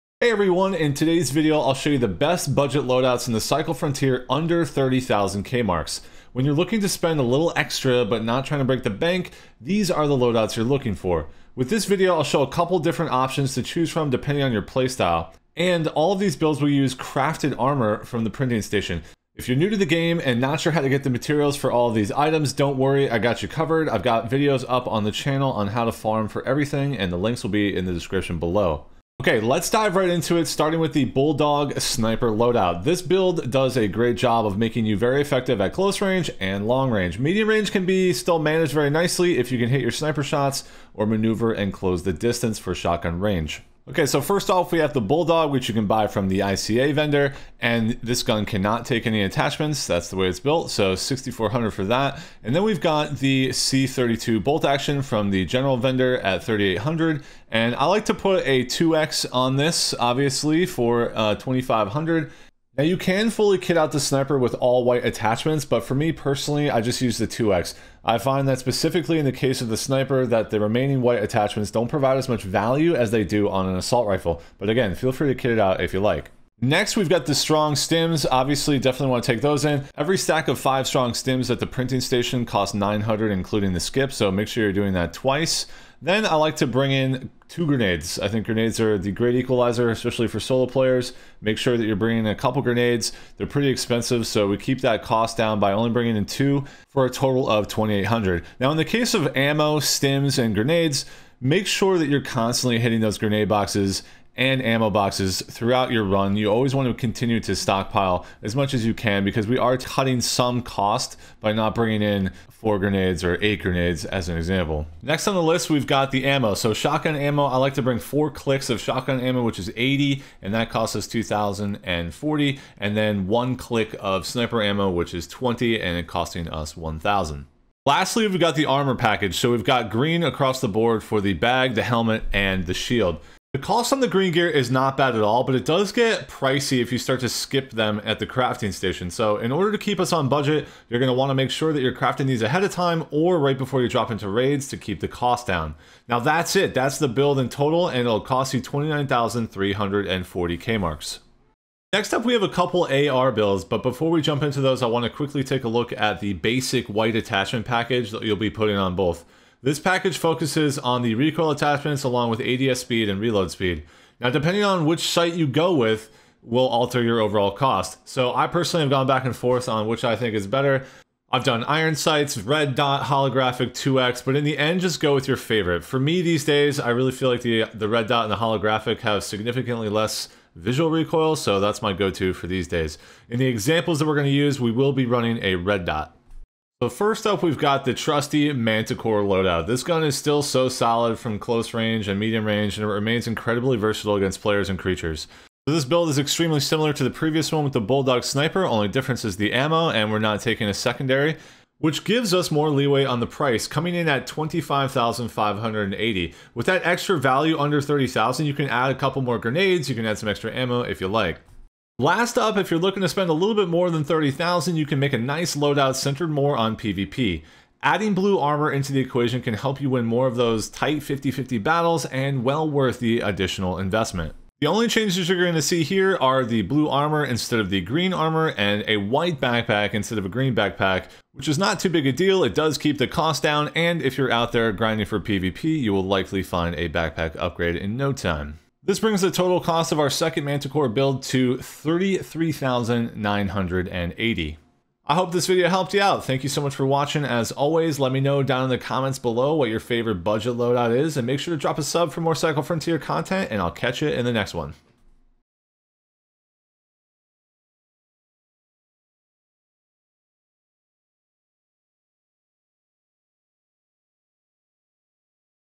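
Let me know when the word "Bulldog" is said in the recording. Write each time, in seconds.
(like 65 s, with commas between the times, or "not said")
31 s, 45 s, 197 s.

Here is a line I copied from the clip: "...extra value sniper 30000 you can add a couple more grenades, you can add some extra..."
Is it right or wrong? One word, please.
wrong.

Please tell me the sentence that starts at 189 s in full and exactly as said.
This gun is still so solid from close range and medium range, and it remains incredibly versatile against players and creatures.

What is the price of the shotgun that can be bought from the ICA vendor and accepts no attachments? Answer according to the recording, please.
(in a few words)
6400.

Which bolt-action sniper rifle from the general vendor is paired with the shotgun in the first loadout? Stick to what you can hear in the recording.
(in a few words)
C32.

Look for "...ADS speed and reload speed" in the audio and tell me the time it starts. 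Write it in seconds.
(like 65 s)
162 s.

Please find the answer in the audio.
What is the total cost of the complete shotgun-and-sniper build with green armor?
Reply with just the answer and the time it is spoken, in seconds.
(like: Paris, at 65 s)
29,340 K-marks, at 148 s.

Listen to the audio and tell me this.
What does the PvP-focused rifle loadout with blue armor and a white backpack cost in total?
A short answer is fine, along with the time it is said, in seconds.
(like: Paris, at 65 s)
33,980, at 241 s.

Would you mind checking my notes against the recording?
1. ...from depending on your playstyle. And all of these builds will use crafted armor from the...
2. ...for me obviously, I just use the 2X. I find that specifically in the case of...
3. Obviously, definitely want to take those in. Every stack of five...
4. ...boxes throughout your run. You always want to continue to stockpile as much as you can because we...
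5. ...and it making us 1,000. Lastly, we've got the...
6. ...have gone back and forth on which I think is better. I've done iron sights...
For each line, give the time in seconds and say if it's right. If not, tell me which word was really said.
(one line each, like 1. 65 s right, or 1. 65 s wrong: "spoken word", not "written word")
1. 13 s right
2. 65 s wrong: "personally", not "obviously"
3. 78 s right
4. 104 s right
5. 125 s wrong: "costing", not "making"
6. 168 s right.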